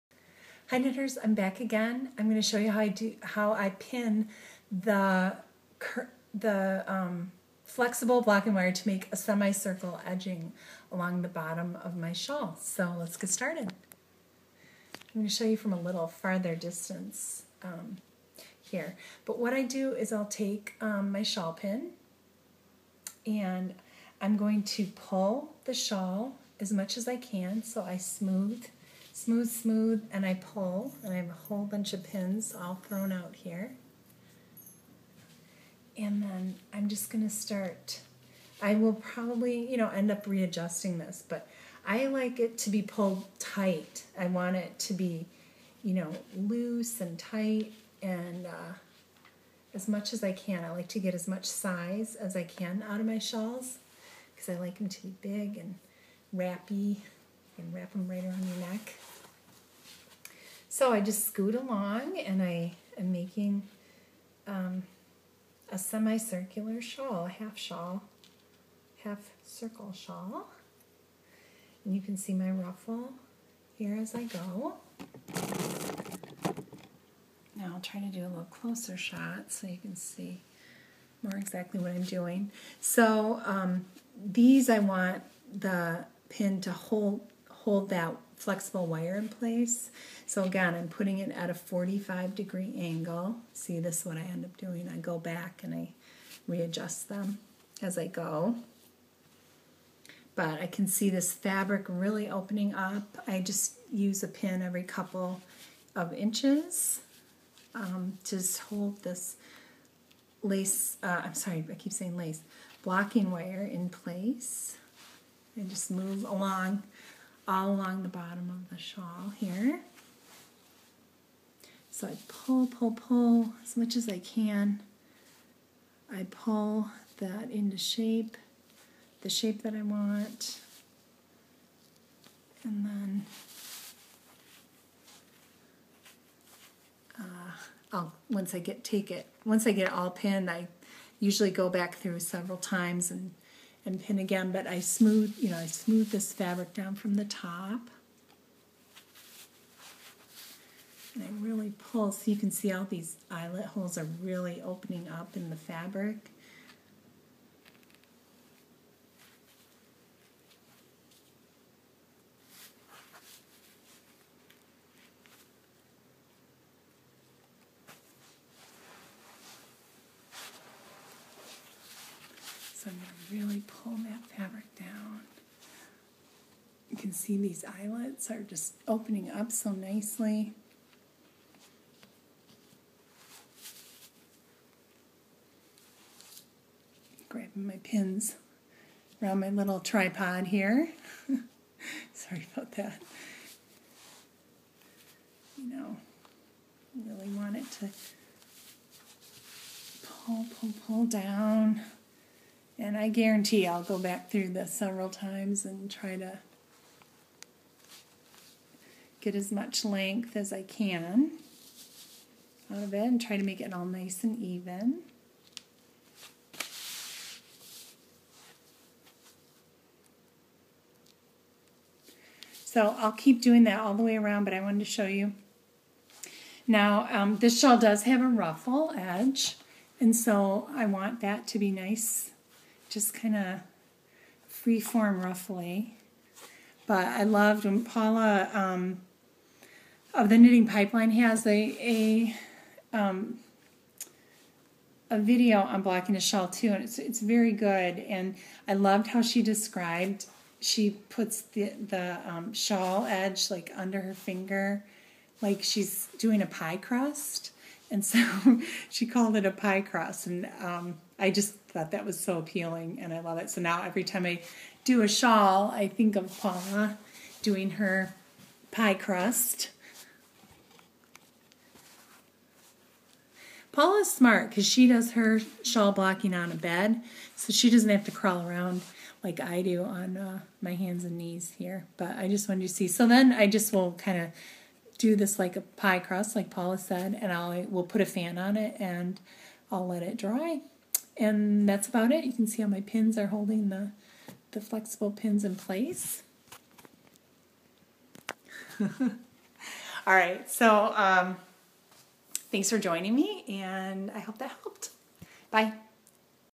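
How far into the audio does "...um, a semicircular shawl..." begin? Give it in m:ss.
1:04.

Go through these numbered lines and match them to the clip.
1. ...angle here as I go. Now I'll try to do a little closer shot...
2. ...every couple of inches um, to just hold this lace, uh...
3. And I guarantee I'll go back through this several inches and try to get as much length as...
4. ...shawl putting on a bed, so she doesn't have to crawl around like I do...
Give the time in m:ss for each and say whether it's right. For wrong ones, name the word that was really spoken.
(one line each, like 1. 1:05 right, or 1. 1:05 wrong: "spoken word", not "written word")
1. 1:12 wrong: "ruffle", not "angle"
2. 1:44 right
3. 3:22 wrong: "times", not "inches"
4. 4:35 wrong: "blocking", not "putting".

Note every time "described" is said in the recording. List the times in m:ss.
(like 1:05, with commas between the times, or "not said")
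4:09.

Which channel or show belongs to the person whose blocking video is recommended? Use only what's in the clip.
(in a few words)
Knitting Pipeline.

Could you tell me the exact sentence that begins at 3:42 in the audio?
So I'll keep doing that all the way around, but I wanted to show you.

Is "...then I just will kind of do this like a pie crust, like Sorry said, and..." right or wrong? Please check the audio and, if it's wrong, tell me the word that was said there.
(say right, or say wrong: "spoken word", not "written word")
wrong: "Paula", not "Sorry".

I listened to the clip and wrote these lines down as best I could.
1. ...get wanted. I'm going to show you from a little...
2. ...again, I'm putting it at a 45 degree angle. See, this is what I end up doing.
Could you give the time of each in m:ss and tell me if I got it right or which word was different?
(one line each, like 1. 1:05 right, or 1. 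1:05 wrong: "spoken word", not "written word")
1. 0:13 wrong: "started", not "wanted"
2. 1:30 right.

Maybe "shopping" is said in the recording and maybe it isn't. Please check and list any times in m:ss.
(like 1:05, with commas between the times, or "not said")
not said.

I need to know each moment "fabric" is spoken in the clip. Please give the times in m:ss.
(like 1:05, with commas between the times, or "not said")
1:41, 2:26, 2:35, 2:54.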